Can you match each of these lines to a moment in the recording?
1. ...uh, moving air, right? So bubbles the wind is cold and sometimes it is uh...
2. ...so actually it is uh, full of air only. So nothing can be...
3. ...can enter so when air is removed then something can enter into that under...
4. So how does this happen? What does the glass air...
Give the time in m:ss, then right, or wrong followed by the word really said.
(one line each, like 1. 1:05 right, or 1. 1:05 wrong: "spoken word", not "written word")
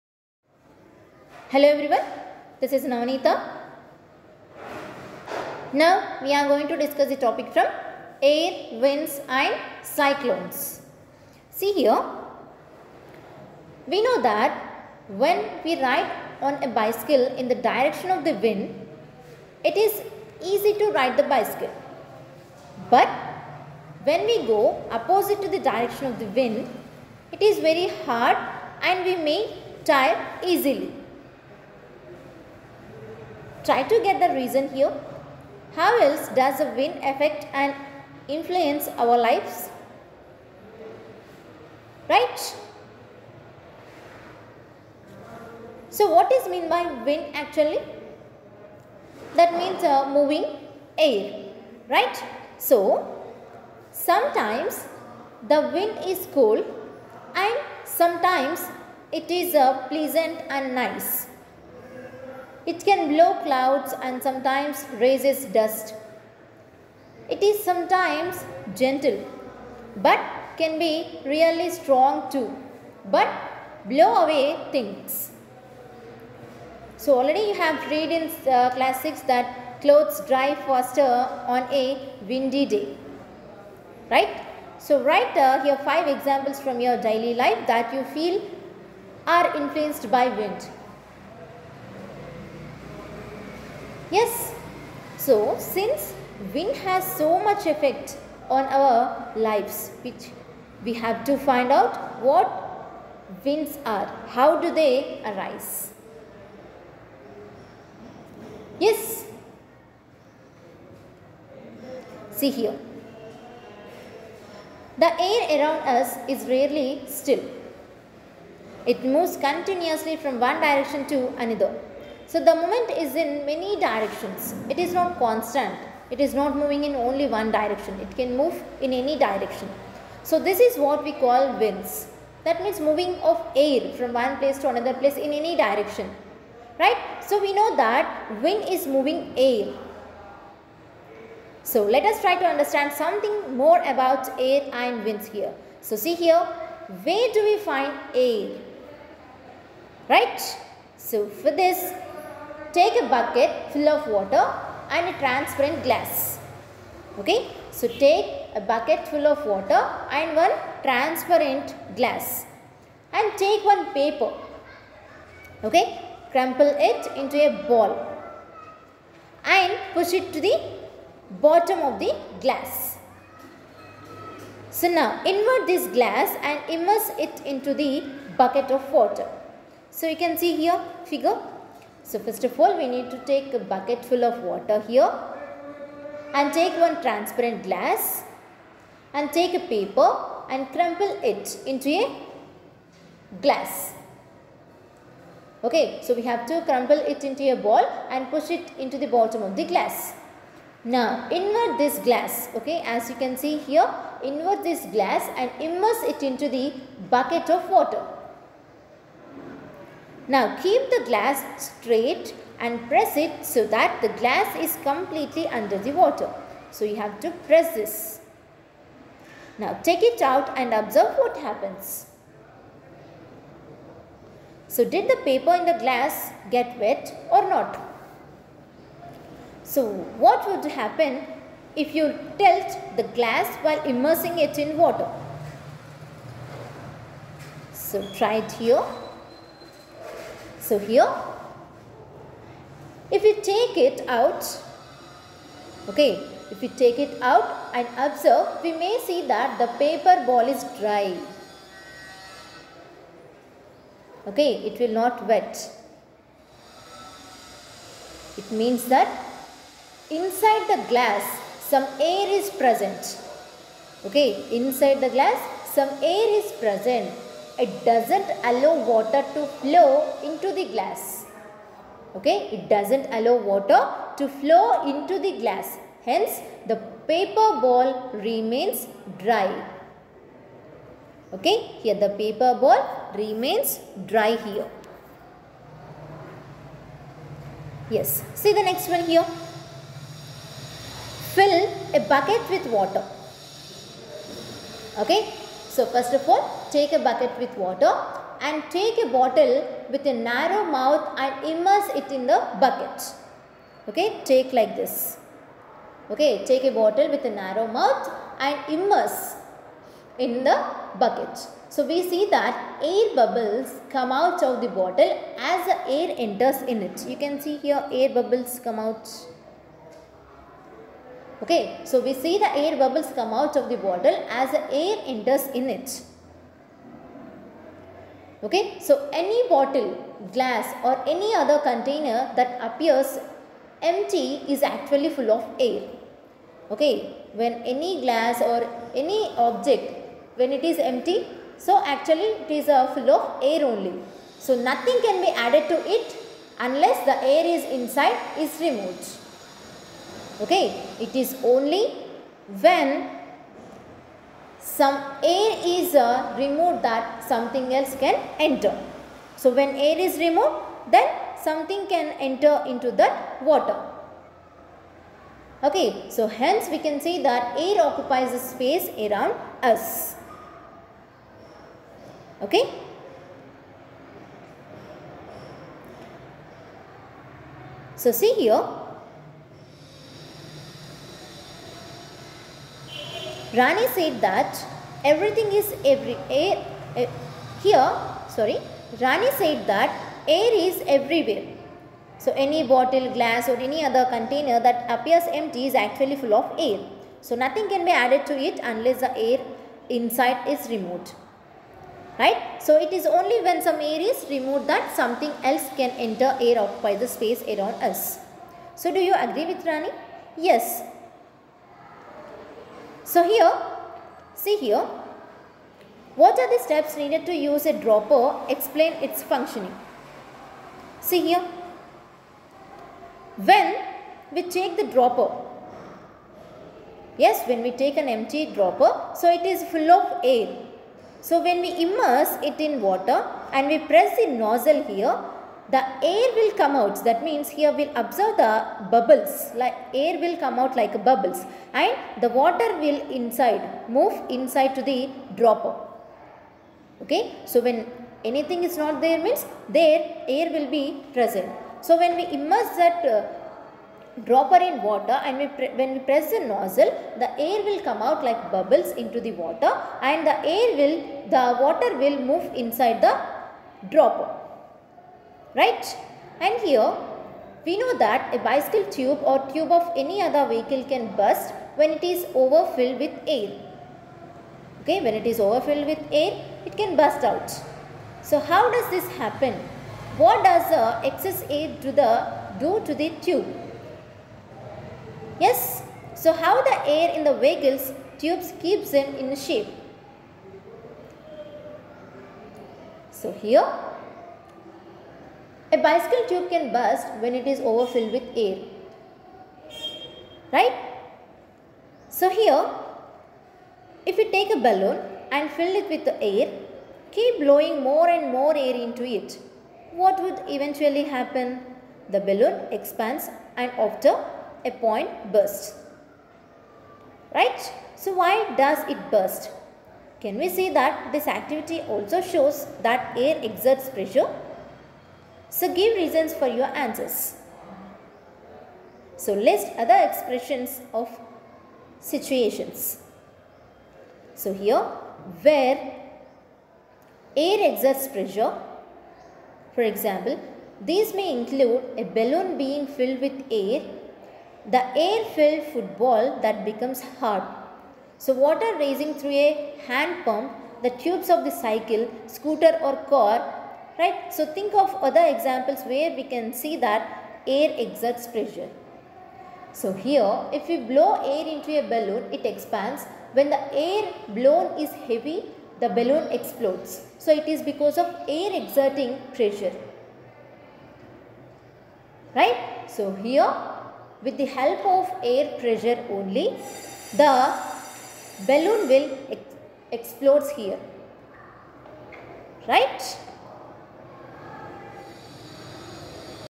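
1. 0:49 wrong: "sometimes", not "bubbles"
2. 5:41 right
3. 5:58 wrong: "water", not "under"
4. 7:58 wrong: "excess", not "glass".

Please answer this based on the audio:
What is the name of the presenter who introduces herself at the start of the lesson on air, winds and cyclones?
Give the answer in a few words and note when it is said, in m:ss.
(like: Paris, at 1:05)
Navneeta, at 0:02.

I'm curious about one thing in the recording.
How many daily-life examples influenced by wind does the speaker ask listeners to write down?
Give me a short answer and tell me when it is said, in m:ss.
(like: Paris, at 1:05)
5, at 1:25.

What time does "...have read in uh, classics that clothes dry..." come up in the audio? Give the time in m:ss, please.
1:17.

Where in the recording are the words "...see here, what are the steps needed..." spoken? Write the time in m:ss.
6:54.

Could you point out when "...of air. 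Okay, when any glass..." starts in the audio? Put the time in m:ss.
5:35.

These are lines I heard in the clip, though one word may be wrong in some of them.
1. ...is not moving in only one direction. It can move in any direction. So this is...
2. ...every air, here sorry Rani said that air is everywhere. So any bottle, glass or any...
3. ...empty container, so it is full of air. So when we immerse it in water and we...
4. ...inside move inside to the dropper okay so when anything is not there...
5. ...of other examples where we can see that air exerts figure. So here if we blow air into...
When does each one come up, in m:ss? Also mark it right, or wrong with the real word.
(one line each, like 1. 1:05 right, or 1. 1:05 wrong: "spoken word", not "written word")
1. 2:06 right
2. 6:25 right
3. 7:08 wrong: "dropper", not "container"
4. 7:23 right
5. 9:14 wrong: "pressure", not "figure".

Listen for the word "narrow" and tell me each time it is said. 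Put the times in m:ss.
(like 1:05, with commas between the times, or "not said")
5:00, 5:07.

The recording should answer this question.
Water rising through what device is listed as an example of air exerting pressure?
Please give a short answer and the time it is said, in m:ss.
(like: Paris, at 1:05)
hand pump, at 9:09.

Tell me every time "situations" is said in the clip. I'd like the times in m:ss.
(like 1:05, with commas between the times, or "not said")
8:51.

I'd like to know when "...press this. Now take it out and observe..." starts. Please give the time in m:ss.
3:37.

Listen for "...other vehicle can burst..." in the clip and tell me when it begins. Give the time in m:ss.
7:50.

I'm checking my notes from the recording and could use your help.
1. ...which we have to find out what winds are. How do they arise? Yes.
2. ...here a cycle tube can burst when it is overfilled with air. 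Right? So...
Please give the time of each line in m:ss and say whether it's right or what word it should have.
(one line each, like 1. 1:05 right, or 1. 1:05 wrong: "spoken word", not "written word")
1. 1:40 right
2. 8:13 wrong: "bicycle", not "cycle".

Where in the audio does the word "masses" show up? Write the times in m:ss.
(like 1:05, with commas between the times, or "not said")
not said.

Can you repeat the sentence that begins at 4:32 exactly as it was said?
Okay, it doesn't allow water to flow into the glass.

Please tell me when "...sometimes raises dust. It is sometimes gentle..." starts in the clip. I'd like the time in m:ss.
1:04.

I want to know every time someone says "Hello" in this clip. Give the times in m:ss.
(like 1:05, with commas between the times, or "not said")
0:01.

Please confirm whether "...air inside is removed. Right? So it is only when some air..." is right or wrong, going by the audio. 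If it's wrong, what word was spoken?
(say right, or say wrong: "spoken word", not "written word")
right.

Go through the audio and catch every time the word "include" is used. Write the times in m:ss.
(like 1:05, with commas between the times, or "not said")
9:01.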